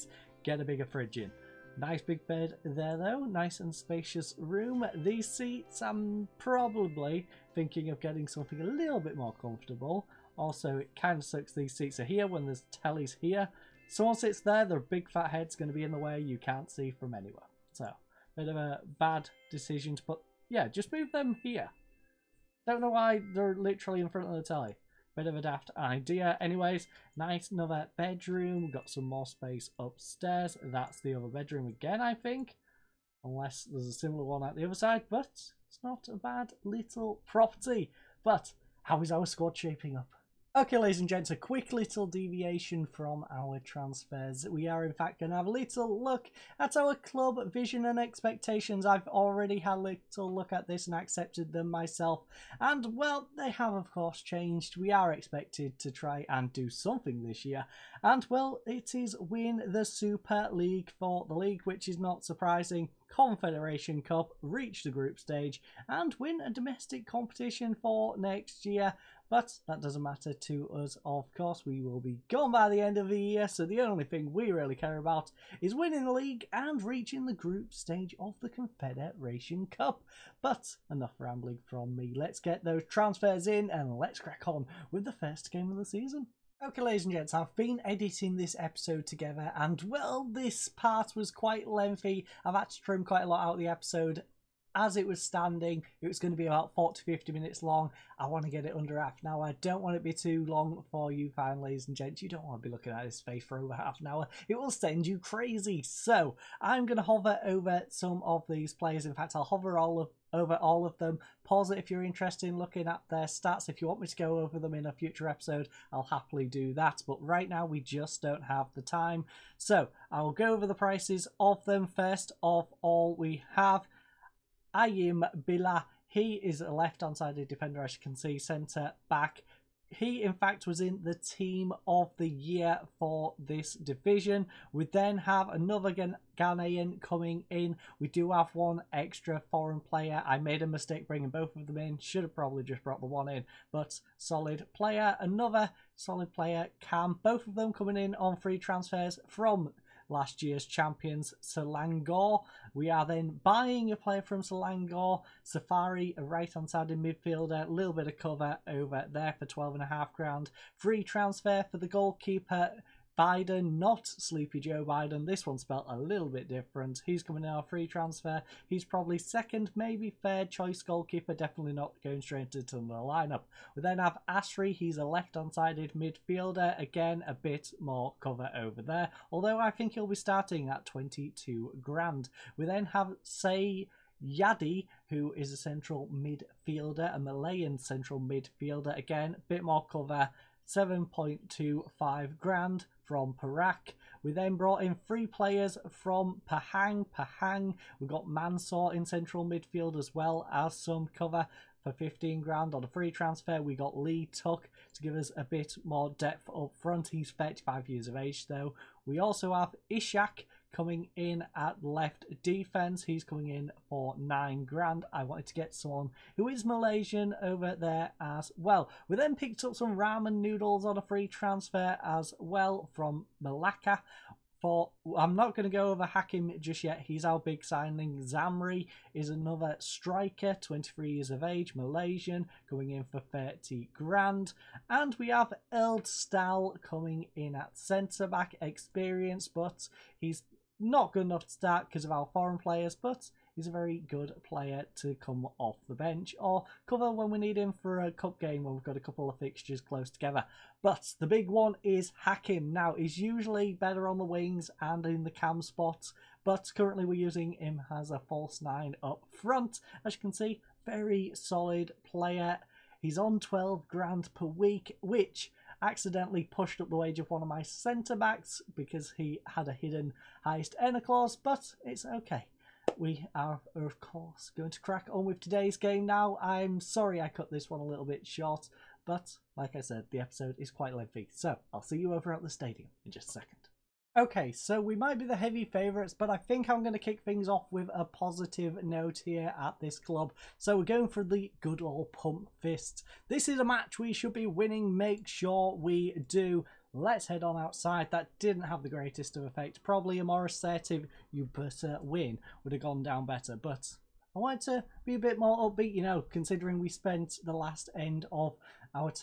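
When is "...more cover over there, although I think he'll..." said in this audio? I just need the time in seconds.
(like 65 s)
177 s.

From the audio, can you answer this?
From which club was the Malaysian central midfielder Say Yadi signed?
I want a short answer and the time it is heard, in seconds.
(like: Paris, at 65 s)
Perak, at 193 s.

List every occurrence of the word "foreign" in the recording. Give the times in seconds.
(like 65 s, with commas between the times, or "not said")
139 s, 242 s.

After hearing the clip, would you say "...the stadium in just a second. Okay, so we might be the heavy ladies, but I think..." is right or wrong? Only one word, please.
wrong.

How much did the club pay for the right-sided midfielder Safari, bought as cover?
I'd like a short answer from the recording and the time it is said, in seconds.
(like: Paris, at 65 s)
12,500, at 159 s.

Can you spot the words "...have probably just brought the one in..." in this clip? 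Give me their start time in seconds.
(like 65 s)
142 s.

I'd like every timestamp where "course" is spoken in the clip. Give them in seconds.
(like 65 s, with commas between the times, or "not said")
53 s, 71 s, 274 s.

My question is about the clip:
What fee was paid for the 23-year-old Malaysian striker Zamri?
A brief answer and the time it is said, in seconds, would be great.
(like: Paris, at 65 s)
30 grand, at 233 s.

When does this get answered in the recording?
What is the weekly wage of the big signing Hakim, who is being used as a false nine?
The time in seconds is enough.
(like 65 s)
263 s.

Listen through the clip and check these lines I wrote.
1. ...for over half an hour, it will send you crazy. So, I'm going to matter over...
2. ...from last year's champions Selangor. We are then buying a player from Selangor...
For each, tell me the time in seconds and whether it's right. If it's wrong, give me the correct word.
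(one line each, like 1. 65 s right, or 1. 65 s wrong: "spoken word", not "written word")
1. 103 s wrong: "hover", not "matter"
2. 149 s right.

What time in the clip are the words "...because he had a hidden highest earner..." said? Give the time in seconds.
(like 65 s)
268 s.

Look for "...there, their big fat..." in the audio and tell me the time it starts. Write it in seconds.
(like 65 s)
14 s.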